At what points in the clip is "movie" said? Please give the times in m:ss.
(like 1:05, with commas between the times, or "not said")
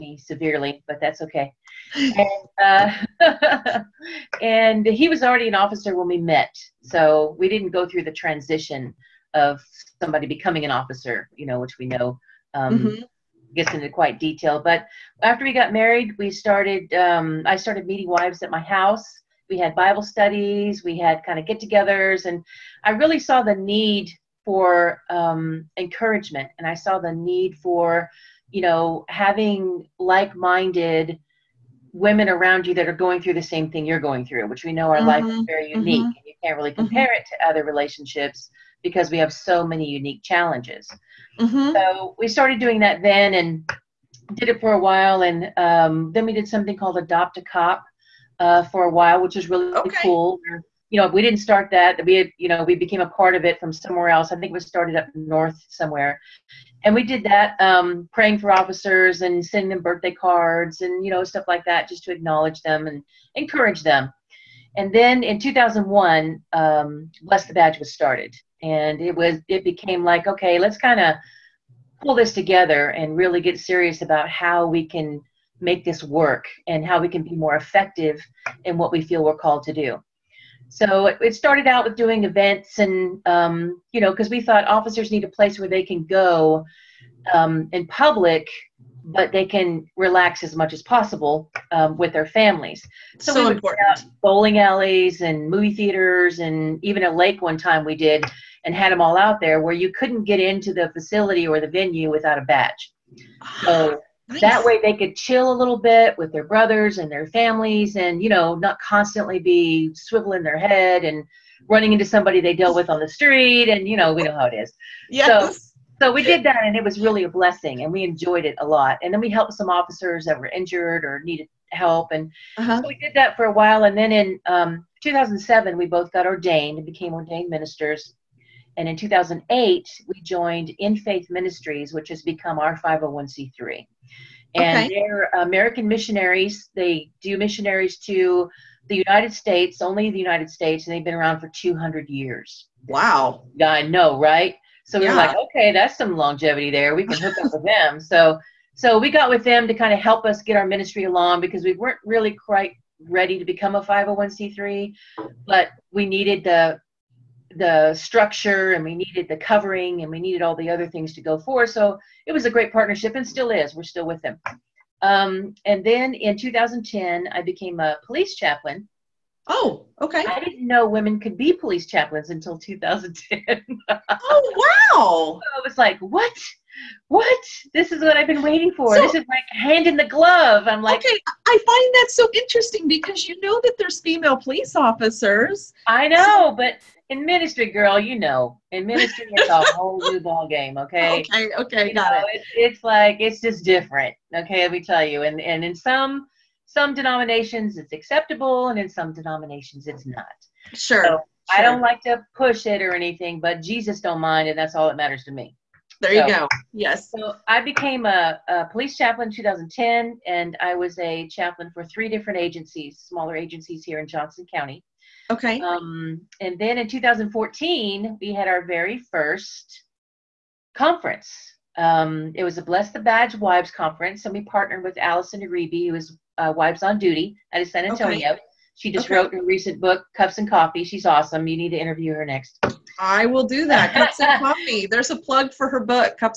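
1:35.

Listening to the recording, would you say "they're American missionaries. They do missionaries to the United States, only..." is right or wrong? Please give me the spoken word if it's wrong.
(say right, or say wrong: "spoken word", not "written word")
right.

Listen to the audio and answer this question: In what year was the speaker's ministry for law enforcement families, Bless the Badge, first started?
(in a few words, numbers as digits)
2001.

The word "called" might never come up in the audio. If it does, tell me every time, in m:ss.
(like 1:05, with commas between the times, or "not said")
0:46, 1:19.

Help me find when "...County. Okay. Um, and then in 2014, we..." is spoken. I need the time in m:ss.
3:34.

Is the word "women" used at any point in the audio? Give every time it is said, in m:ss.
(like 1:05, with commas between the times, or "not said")
0:31, 2:50.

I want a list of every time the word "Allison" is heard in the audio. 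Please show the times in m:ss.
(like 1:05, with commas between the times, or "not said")
3:44.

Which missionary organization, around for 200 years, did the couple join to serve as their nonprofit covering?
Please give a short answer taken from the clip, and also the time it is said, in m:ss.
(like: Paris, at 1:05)
InFaith Ministries, at 2:10.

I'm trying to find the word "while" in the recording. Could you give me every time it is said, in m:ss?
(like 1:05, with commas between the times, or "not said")
0:44, 0:48, 2:03.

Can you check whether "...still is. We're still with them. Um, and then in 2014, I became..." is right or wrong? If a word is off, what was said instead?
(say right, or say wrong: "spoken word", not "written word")
wrong: "2010", not "2014".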